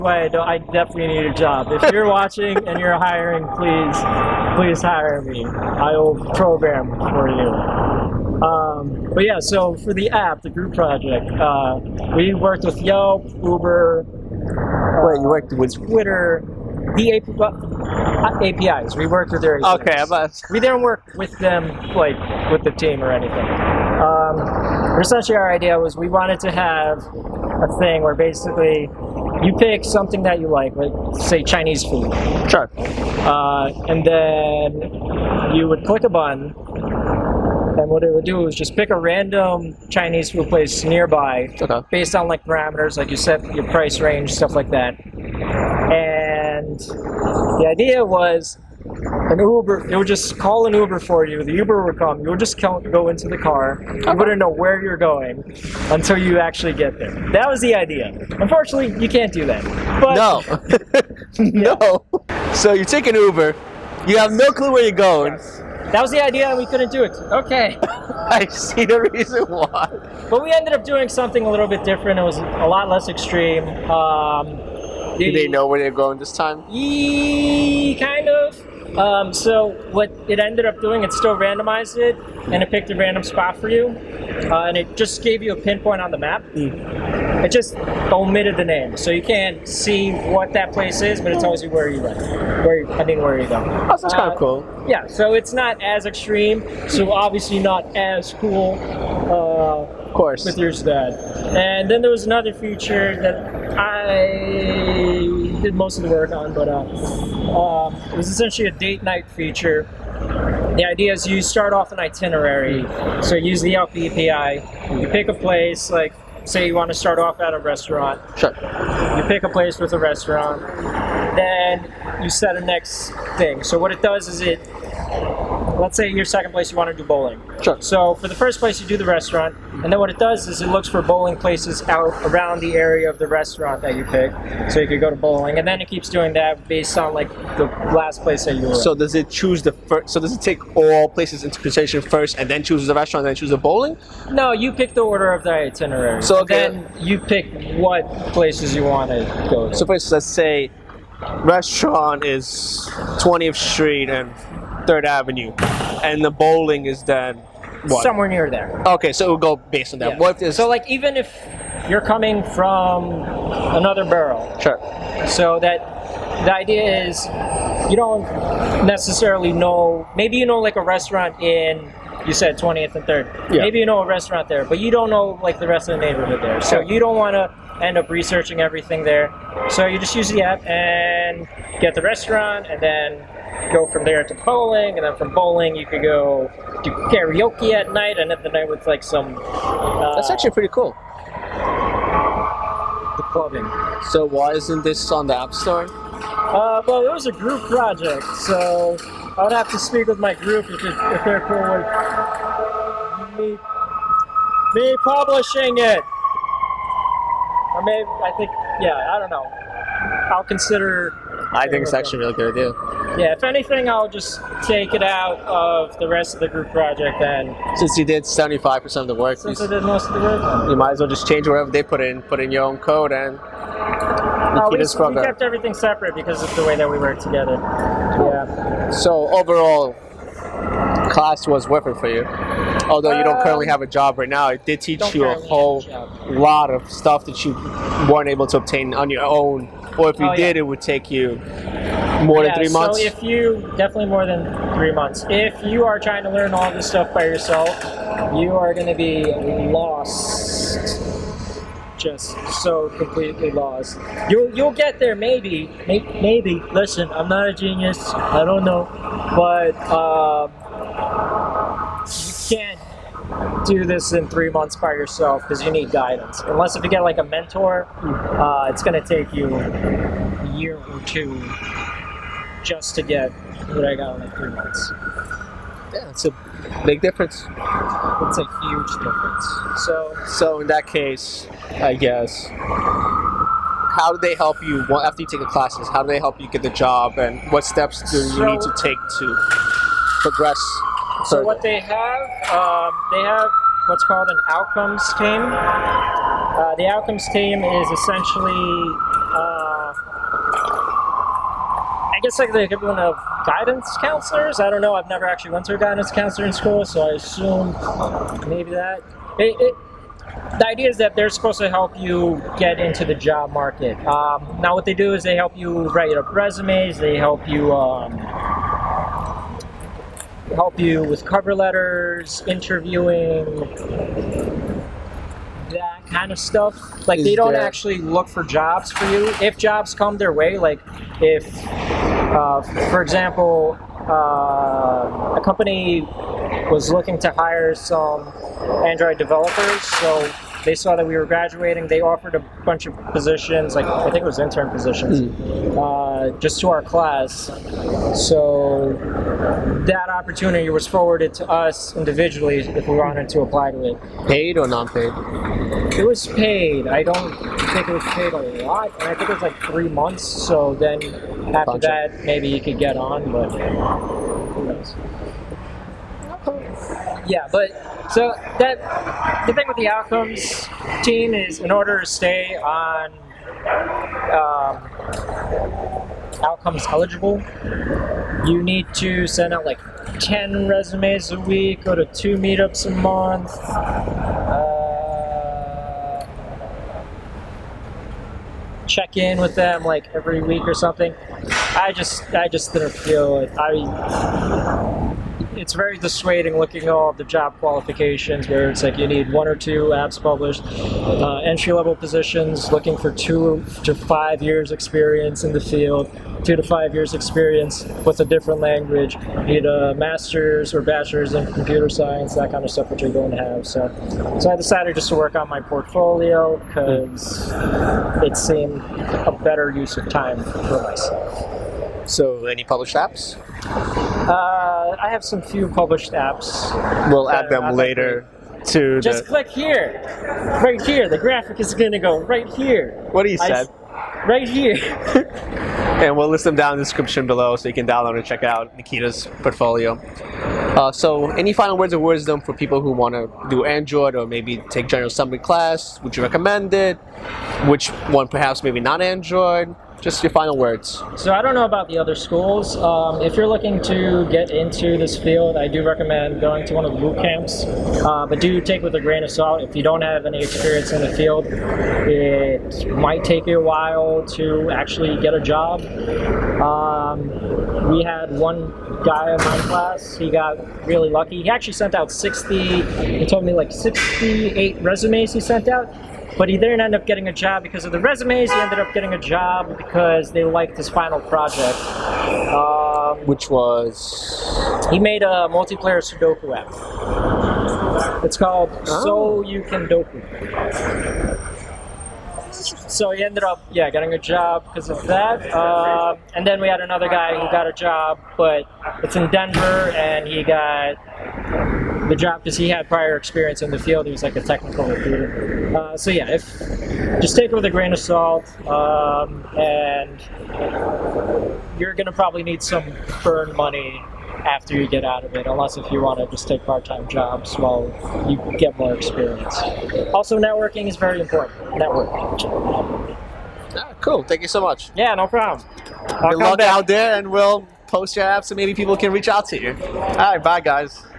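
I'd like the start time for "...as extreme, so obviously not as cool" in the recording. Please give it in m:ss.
1:35.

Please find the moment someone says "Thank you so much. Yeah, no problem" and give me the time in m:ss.
8:44.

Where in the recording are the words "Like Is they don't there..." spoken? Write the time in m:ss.
5:27.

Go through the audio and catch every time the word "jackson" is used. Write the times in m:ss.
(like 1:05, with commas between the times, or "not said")
not said.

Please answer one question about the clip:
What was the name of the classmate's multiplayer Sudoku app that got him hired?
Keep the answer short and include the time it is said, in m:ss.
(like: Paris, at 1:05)
So You Can Doku, at 8:09.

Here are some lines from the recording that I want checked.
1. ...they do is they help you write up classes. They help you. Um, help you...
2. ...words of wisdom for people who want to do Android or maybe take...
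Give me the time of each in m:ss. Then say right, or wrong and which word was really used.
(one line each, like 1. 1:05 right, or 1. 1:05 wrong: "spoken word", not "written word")
1. 5:14 wrong: "resumes", not "classes"
2. 7:21 right.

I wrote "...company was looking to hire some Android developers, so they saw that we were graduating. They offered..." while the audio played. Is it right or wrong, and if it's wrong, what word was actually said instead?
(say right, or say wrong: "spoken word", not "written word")
right.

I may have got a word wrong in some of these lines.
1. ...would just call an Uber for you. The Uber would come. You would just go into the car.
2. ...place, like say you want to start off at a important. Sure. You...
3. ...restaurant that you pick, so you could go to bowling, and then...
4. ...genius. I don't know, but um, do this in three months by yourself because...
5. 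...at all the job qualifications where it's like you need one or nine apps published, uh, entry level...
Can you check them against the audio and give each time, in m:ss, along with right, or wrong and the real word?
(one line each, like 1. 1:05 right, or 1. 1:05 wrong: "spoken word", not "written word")
1. 0:49 right
2. 1:55 wrong: "restaurant", not "important"
3. 2:13 right
4. 4:17 right
5. 6:36 wrong: "two", not "nine".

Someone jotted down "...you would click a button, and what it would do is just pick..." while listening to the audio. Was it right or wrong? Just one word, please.
right.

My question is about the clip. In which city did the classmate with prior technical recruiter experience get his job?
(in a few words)
Denver.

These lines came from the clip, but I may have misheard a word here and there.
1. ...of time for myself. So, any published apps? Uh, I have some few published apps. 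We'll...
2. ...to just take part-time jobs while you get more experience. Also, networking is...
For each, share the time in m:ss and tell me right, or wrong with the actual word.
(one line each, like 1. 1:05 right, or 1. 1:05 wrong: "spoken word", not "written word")
1. 6:59 right
2. 8:36 right.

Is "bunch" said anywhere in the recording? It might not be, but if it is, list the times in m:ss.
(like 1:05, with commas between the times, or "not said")
5:42, 6:01.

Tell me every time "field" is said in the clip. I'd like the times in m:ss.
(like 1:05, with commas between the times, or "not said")
6:45, 7:35, 7:41, 8:23.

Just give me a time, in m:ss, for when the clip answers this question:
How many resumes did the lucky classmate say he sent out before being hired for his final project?
7:53.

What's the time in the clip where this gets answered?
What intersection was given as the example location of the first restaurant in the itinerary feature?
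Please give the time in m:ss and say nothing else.
2:33.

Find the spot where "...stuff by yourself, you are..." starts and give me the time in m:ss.
4:06.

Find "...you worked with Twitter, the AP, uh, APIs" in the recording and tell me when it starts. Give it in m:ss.
0:15.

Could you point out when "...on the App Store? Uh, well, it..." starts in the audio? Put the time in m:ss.
3:15.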